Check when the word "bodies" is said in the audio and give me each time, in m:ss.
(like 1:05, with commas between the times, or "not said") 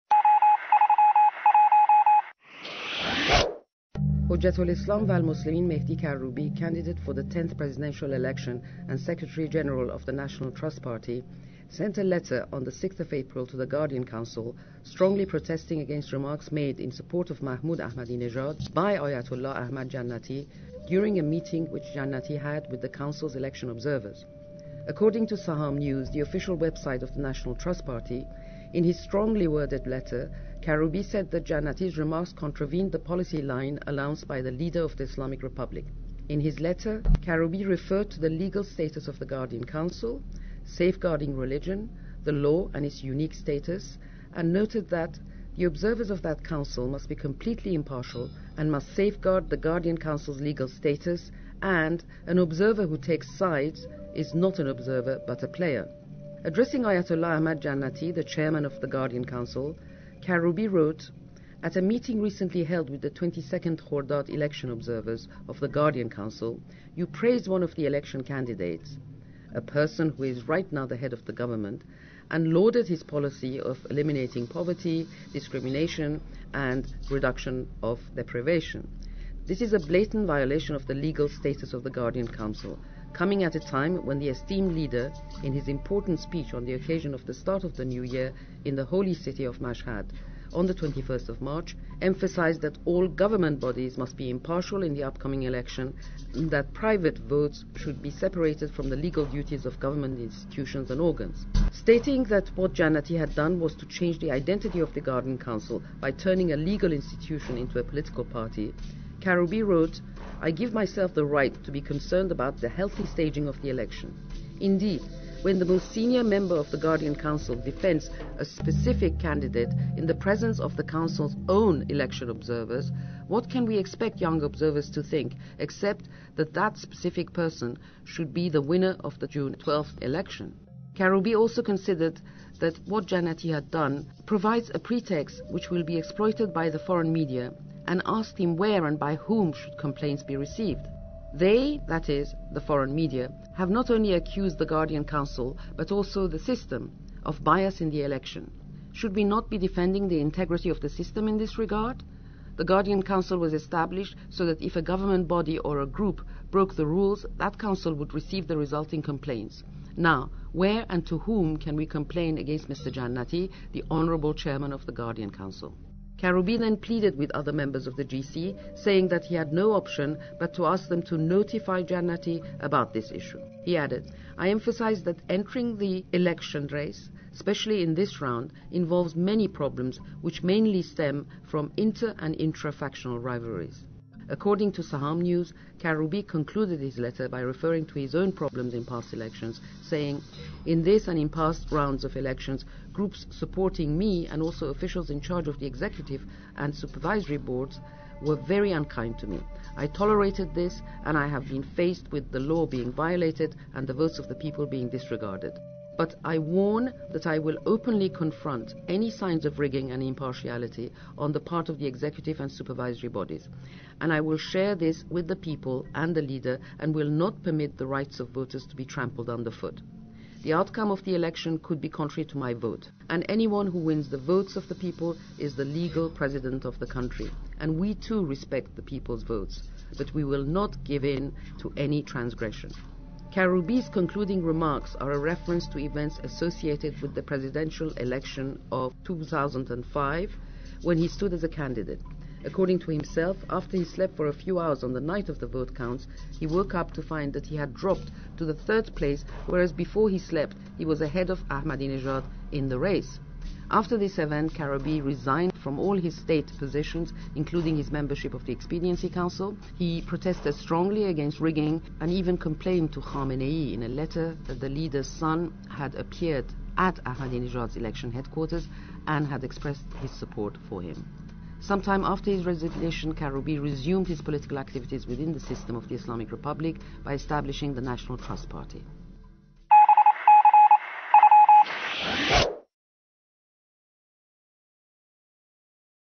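1:33, 3:33.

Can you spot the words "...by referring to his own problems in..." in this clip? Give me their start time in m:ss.
3:07.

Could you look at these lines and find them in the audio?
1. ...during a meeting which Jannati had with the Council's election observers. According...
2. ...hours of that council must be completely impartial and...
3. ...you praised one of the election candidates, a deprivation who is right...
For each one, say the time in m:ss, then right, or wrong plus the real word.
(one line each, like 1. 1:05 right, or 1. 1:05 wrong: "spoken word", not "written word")
1. 0:20 right
2. 0:45 wrong: "observers", not "hours"
3. 1:06 wrong: "person", not "deprivation".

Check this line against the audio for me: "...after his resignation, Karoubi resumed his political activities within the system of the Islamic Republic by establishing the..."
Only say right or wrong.
right.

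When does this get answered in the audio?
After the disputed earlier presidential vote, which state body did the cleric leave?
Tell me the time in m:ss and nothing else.
4:18.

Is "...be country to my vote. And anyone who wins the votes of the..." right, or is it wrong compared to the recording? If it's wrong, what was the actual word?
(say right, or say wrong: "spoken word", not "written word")
wrong: "contrary", not "country".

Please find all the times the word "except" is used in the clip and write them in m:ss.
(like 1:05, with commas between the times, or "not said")
2:05.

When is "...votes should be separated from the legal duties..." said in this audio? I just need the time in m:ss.
1:37.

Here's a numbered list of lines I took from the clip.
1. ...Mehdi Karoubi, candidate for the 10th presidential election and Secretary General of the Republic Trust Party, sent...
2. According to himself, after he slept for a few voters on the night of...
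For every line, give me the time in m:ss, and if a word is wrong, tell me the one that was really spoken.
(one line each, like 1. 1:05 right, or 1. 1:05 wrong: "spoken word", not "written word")
1. 0:05 wrong: "National", not "Republic"
2. 4:02 wrong: "hours", not "voters".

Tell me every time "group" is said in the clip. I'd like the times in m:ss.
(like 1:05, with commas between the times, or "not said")
2:35, 3:12.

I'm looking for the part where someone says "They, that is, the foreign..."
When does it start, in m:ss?
2:21.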